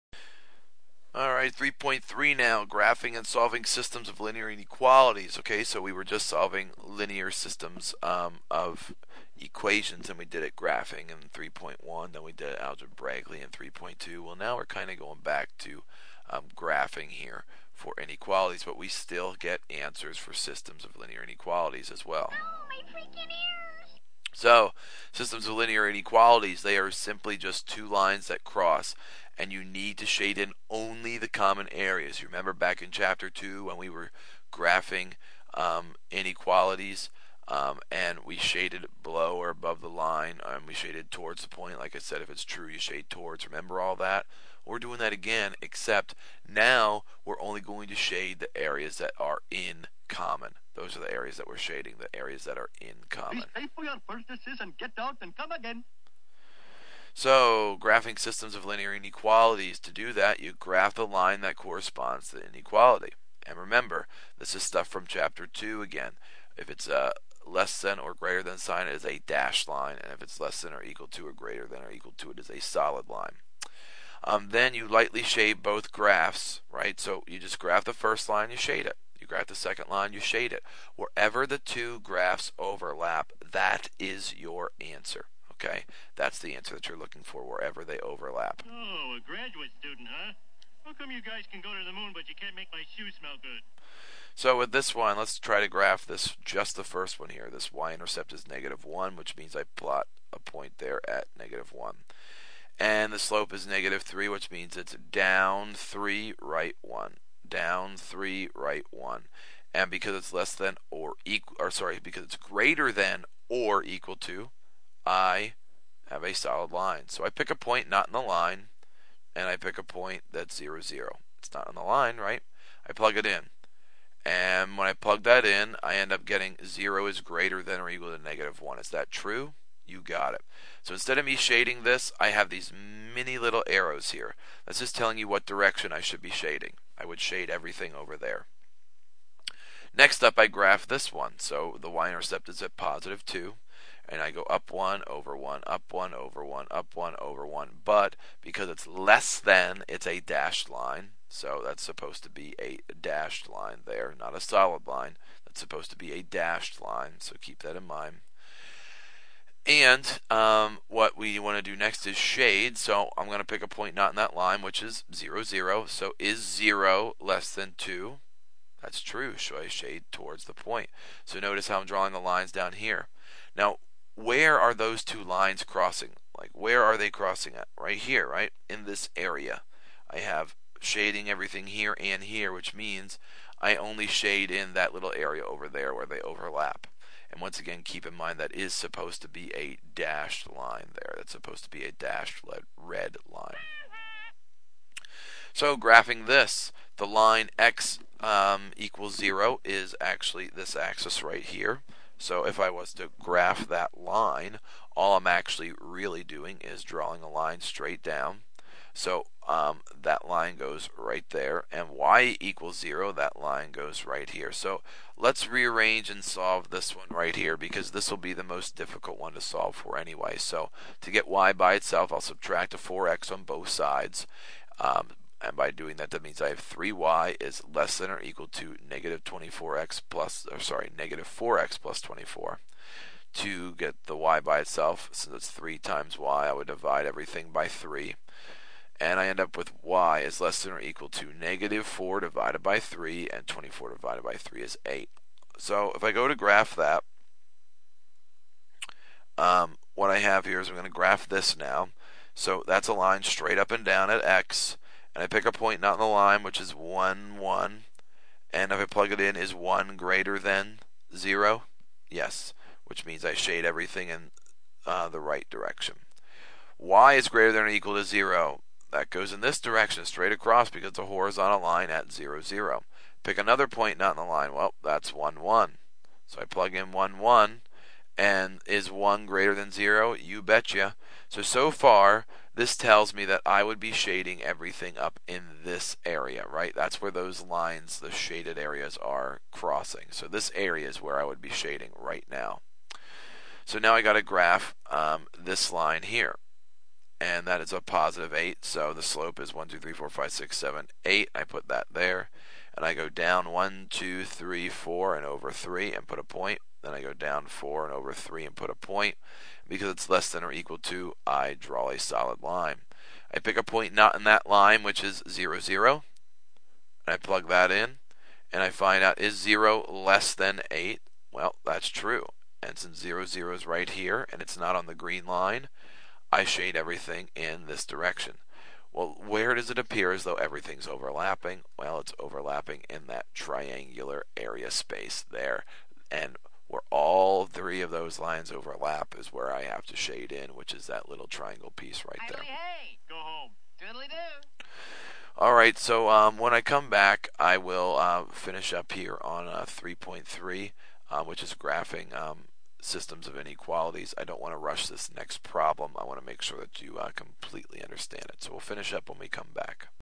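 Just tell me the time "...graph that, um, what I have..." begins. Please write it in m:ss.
4:06.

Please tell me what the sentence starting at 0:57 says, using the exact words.
So, graphing systems of linear inequalities, to do that, you graph the line that corresponds to the inequality.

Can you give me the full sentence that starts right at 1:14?
Um, then you lightly shade both graphs, right?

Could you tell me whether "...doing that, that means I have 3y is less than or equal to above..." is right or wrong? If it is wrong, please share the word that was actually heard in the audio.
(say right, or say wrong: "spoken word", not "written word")
wrong: "negative", not "above".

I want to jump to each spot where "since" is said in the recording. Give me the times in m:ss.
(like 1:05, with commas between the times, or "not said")
3:55, 5:22.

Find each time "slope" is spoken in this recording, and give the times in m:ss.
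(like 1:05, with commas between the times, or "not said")
1:43, 4:59.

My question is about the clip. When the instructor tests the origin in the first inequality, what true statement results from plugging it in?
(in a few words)
0 is greater than or equal to -1.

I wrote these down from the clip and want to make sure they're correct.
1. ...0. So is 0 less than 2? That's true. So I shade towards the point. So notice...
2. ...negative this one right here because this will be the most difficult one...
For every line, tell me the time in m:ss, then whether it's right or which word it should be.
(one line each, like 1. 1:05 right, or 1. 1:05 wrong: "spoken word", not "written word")
1. 2:45 right
2. 3:36 wrong: "solve", not "negative".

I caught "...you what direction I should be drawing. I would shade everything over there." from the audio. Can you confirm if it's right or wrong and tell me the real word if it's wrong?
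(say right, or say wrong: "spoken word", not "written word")
wrong: "shading", not "drawing".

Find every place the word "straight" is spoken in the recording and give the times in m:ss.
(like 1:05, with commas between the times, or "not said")
3:27, 4:13, 4:30.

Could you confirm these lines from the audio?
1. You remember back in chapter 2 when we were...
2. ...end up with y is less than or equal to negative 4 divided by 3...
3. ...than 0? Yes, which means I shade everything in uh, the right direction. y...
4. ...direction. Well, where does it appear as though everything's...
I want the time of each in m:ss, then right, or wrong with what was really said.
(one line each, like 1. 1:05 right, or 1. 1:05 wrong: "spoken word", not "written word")
1. 0:32 right
2. 3:59 right
3. 4:20 right
4. 5:27 right.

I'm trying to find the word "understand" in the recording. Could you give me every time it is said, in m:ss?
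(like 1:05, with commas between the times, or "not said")
5:57.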